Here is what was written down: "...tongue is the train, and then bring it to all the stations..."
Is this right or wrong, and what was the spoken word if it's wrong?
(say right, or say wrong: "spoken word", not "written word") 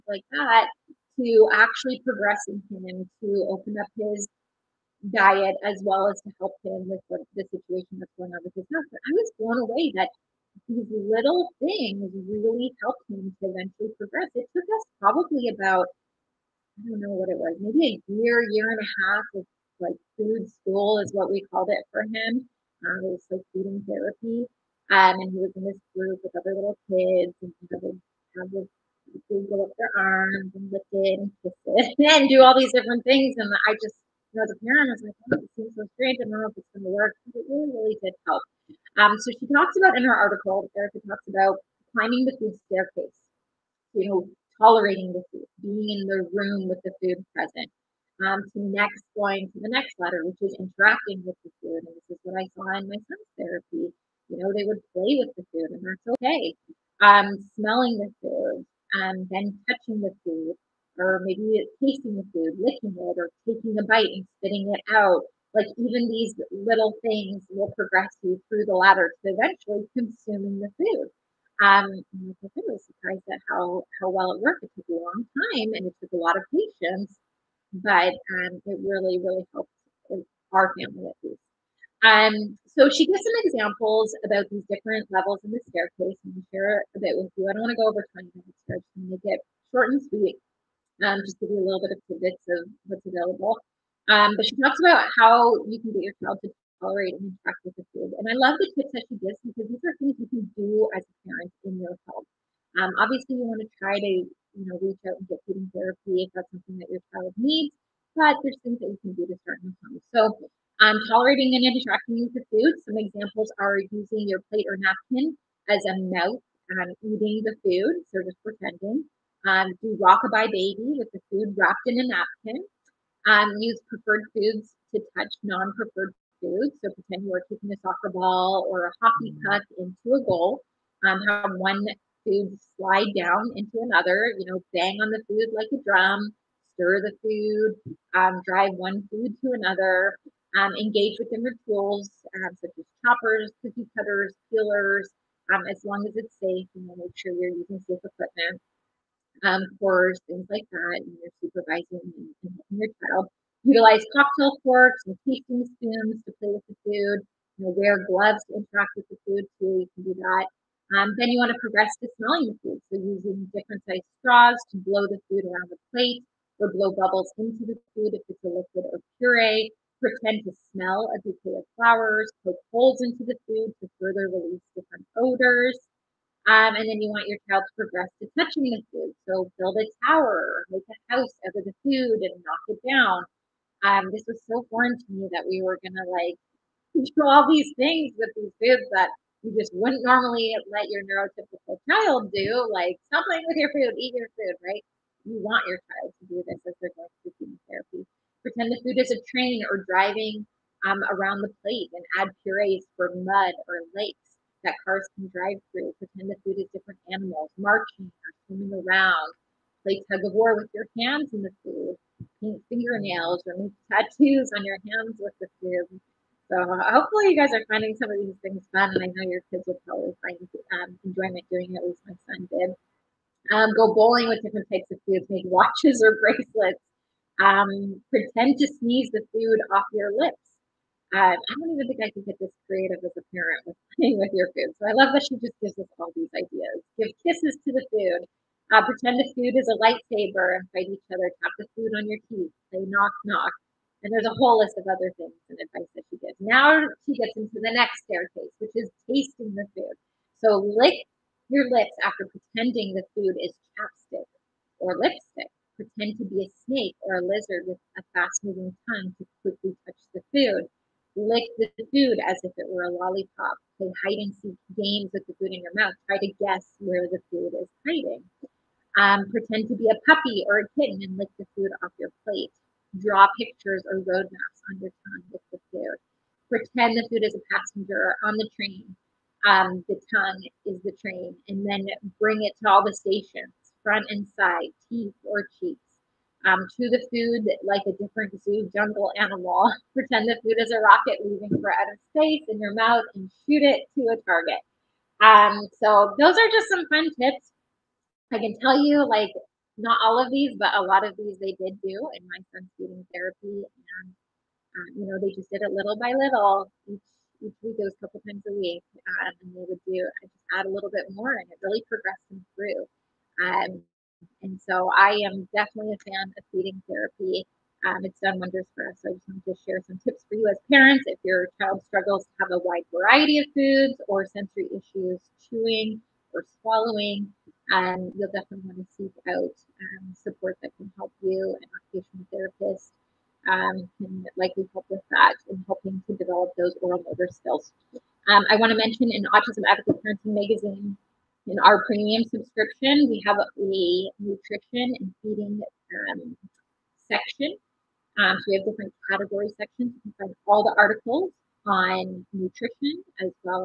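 right.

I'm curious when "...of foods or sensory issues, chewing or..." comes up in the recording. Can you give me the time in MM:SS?
05:23.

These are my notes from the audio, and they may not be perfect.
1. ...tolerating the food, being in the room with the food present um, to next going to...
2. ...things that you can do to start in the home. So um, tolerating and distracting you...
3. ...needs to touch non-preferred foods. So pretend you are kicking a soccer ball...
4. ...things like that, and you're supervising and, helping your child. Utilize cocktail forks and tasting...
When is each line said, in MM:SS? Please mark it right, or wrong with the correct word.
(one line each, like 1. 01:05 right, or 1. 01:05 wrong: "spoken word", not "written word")
1. 00:44 right
2. 01:48 right
3. 02:04 wrong: "foods", not "needs"
4. 02:30 right.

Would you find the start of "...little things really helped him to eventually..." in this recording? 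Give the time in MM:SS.
00:10.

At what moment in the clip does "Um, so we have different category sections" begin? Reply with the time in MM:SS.
05:48.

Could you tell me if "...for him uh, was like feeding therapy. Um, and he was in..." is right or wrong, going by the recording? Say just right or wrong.
right.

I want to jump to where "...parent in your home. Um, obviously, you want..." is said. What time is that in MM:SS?
01:41.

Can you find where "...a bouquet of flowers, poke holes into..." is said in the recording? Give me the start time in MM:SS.
02:51.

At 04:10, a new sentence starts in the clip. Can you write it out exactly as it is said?
So lick your lips after pretending the food is chapstick or lipstick.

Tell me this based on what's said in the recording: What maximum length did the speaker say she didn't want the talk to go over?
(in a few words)
20 minutes.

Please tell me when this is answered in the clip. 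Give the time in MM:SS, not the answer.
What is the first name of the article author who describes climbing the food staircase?
00:40.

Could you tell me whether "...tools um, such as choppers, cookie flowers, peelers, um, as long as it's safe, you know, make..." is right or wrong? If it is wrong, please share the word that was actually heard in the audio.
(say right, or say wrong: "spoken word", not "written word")
wrong: "cutters", not "flowers".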